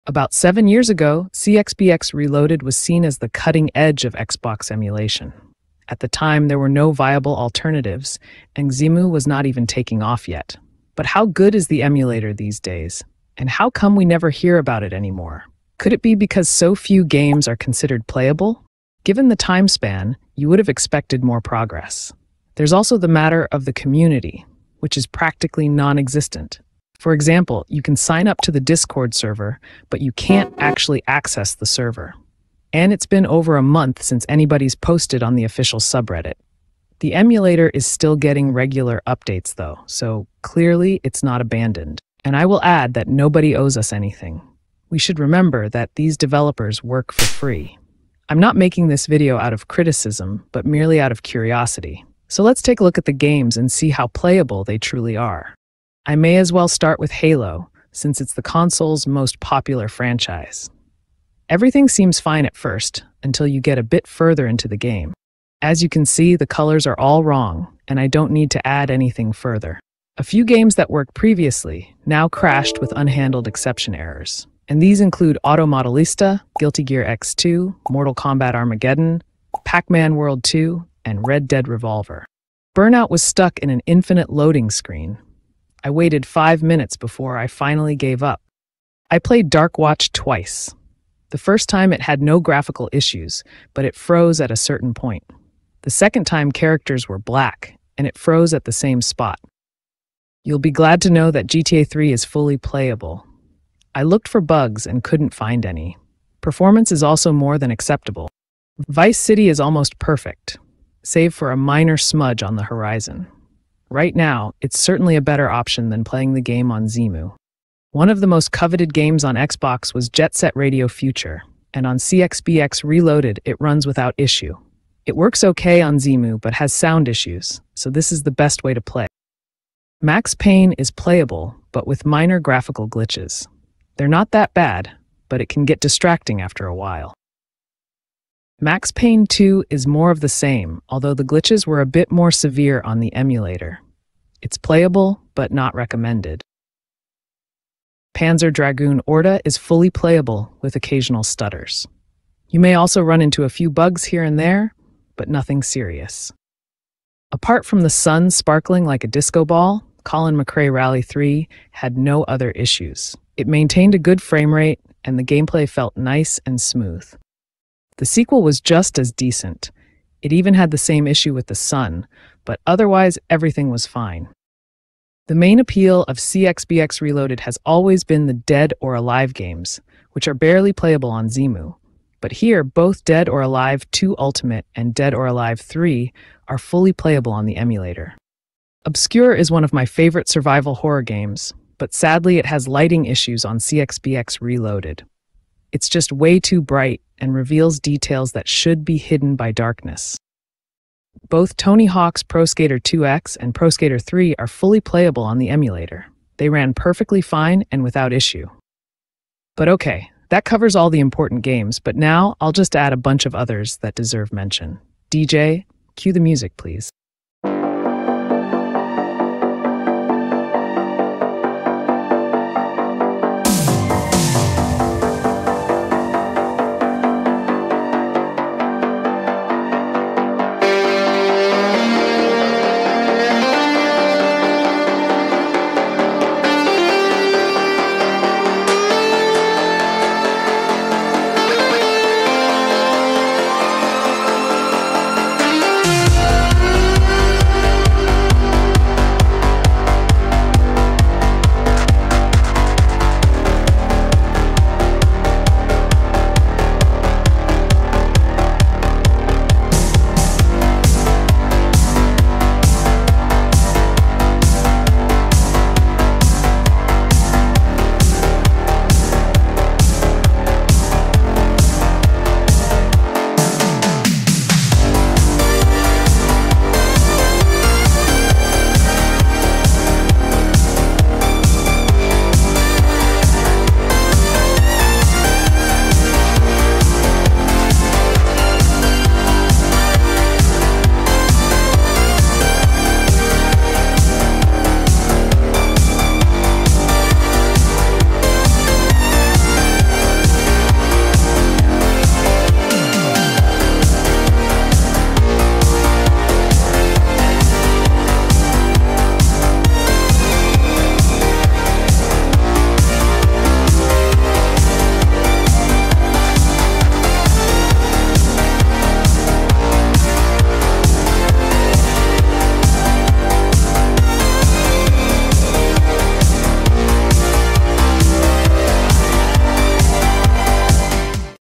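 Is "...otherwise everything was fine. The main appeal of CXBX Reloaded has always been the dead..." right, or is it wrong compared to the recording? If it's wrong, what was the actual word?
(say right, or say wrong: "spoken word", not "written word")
right.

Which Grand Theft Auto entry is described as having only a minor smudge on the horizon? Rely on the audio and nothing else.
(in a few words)
Vice City.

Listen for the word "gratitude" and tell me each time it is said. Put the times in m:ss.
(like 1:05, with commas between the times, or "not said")
not said.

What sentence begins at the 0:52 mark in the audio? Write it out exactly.
So let's take a look at the games and see how playable they truly are.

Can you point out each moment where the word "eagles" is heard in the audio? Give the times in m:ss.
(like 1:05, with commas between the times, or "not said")
not said.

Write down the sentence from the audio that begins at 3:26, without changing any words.
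They ran perfectly fine and without issue.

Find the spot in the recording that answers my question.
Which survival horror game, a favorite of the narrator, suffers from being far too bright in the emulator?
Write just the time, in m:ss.
3:08.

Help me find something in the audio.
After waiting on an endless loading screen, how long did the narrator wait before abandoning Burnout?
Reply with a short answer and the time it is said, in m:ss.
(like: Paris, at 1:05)
5 minutes, at 1:26.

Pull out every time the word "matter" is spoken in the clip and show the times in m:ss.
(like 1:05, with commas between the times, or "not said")
0:23.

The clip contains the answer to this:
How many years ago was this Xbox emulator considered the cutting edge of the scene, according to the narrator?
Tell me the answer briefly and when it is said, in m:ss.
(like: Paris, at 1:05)
7, at 0:00.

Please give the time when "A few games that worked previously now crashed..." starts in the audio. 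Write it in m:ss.
1:10.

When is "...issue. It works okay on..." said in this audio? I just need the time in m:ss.
2:04.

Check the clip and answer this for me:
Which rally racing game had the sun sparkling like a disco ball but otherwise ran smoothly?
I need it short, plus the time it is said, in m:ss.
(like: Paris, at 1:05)
Colin McRae Rally 3, at 2:40.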